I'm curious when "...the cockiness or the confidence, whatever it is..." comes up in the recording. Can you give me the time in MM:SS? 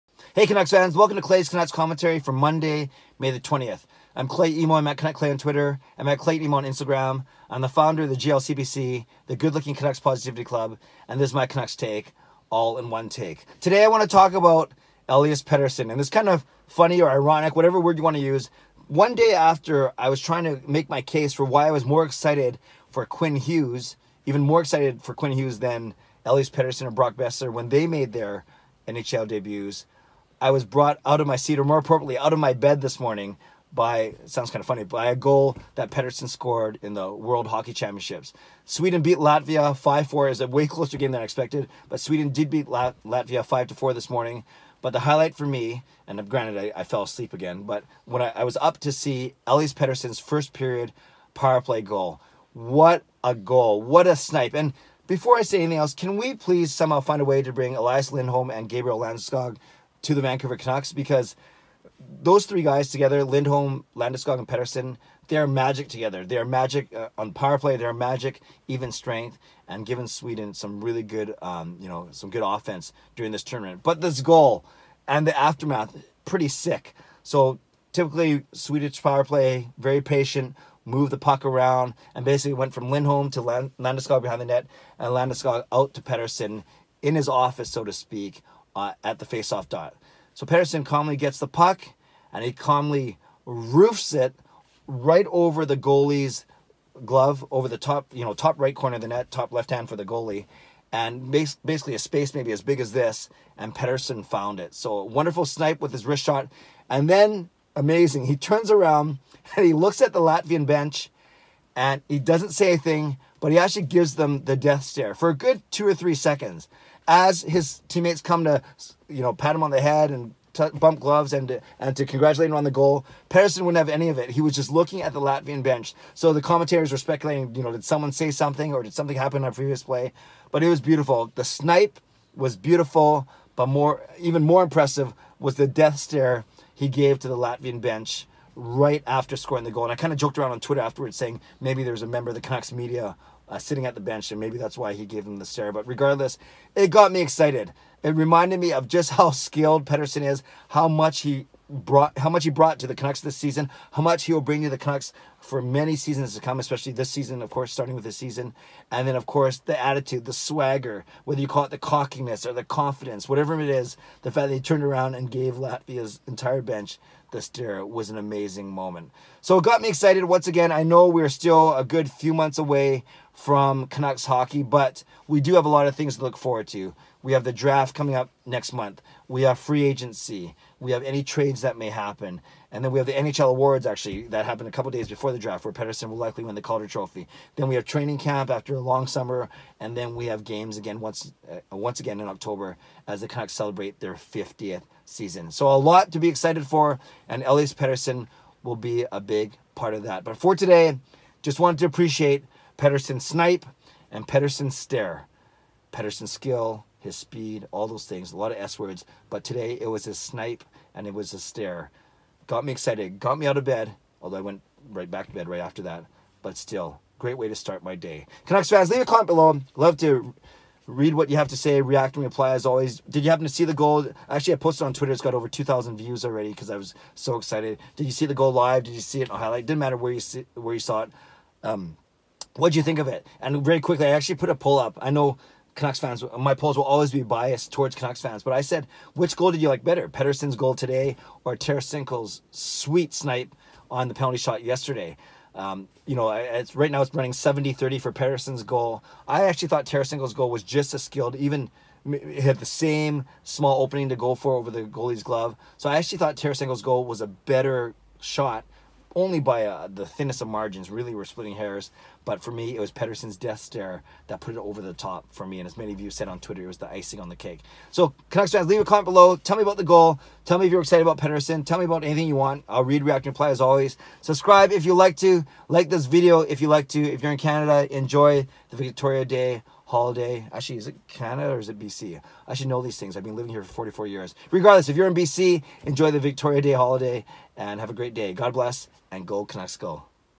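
02:41.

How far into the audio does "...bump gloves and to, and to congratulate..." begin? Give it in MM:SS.
02:00.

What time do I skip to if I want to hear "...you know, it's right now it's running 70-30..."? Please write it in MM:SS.
04:06.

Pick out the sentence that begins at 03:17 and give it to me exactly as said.
And Elias Pettersson will be a big part of that.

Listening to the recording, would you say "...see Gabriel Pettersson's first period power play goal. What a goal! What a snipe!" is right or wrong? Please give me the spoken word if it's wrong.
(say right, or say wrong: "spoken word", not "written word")
wrong: "Elias", not "Gabriel".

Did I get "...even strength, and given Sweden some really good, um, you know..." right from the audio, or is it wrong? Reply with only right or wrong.
right.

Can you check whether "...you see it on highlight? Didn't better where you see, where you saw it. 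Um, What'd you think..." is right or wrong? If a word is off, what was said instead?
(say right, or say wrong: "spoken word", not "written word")
wrong: "matter", not "better".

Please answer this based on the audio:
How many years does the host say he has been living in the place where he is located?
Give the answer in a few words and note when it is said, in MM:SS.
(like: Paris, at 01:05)
44, at 04:43.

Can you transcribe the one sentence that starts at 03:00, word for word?
We have any trades that may happen.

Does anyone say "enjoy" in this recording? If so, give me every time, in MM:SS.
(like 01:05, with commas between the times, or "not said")
04:37, 04:45.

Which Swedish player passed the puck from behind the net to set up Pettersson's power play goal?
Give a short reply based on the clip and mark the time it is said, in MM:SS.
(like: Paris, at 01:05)
Gabriel Landeskog, at 01:25.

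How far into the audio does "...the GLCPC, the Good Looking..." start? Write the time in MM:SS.
00:08.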